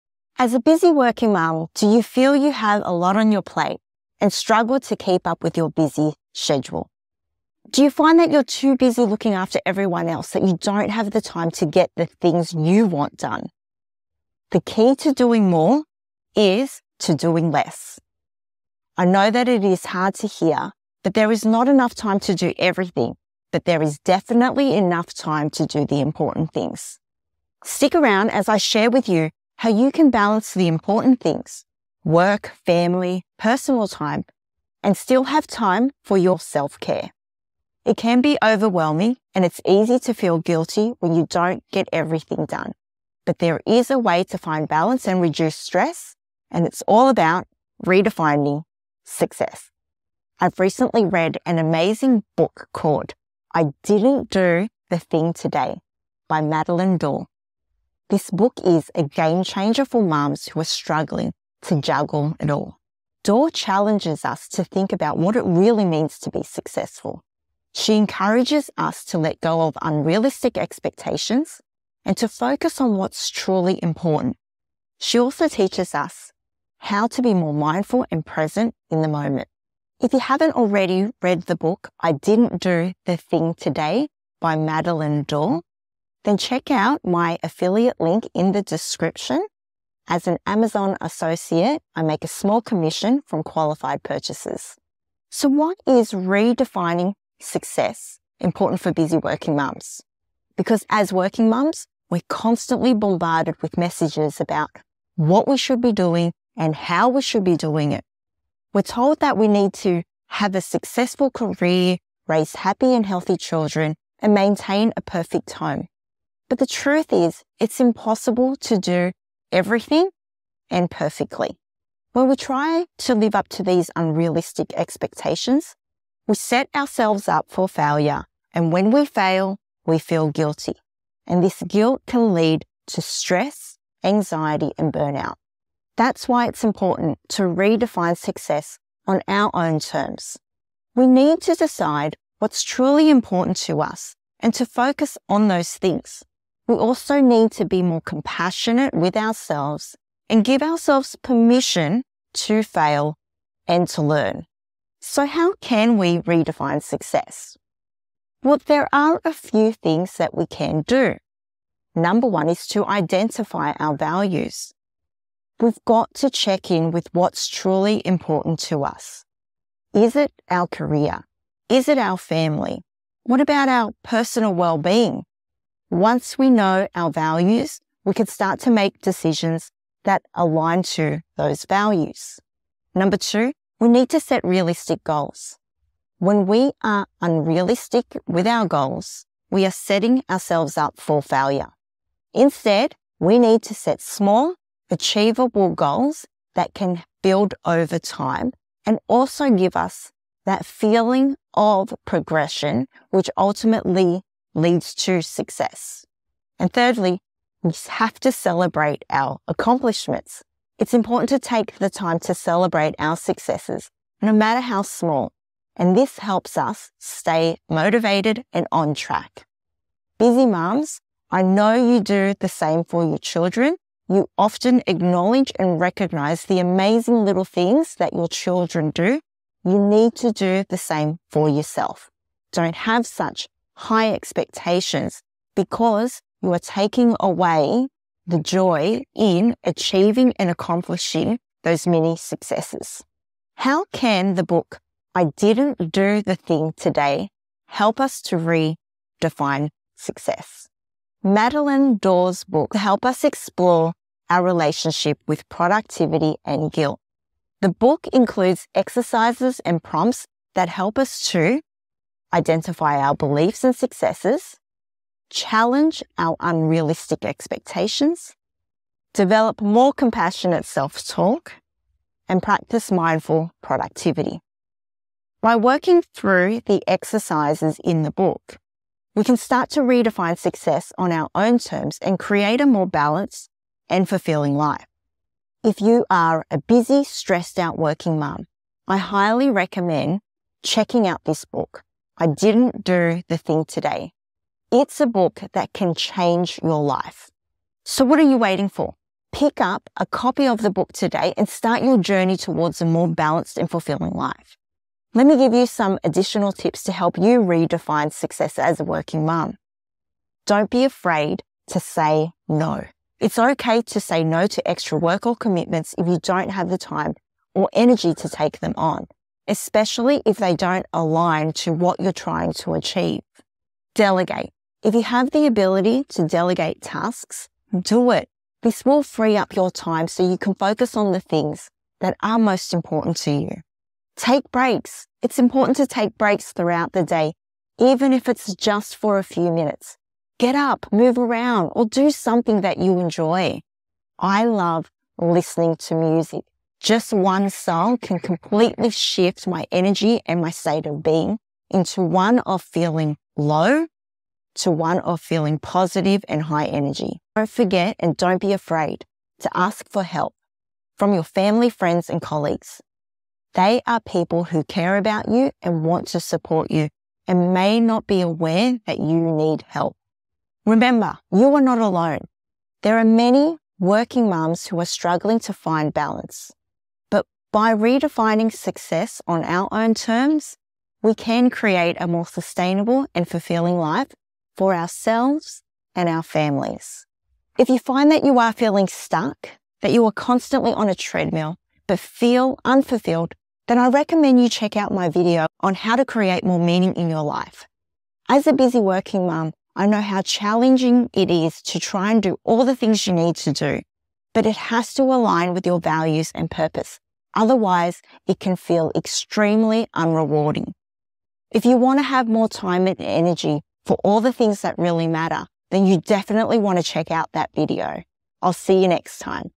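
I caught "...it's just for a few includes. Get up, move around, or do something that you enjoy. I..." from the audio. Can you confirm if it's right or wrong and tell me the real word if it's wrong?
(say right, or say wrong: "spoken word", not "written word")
wrong: "minutes", not "includes".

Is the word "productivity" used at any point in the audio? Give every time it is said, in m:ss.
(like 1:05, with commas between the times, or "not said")
4:15, 4:33.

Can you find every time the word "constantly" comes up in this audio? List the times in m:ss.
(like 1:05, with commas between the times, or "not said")
1:42, 6:30.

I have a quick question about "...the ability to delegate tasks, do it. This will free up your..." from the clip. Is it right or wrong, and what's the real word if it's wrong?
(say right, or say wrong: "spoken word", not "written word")
right.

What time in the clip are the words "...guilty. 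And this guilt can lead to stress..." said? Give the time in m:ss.
2:10.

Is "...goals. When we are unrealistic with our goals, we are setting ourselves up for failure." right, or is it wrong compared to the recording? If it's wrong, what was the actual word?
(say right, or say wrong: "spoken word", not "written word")
right.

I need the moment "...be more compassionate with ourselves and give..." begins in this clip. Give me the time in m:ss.
2:27.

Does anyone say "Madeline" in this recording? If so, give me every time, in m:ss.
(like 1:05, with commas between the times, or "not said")
0:56, 1:24, 4:11.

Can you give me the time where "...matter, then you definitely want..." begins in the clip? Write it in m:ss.
6:55.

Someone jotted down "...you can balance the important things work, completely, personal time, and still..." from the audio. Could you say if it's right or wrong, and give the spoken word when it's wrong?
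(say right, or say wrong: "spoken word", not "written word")
wrong: "family", not "completely".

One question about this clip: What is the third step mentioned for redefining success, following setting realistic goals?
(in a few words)
celebrate our accomplishments.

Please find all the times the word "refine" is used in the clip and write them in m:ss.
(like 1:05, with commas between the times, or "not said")
not said.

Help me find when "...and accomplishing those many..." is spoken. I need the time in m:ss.
4:00.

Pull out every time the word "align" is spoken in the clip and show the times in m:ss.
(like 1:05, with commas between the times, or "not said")
3:00, 5:20, 6:45.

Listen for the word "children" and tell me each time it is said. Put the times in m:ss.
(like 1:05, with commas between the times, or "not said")
1:53, 3:43, 3:48.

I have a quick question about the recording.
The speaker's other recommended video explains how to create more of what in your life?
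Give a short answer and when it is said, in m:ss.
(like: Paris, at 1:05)
meaning, at 6:36.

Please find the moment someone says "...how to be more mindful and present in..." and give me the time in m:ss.
1:16.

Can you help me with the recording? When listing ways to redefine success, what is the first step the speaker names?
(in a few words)
identify our values.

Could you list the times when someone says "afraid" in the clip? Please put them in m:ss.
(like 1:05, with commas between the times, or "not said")
5:10, 5:58.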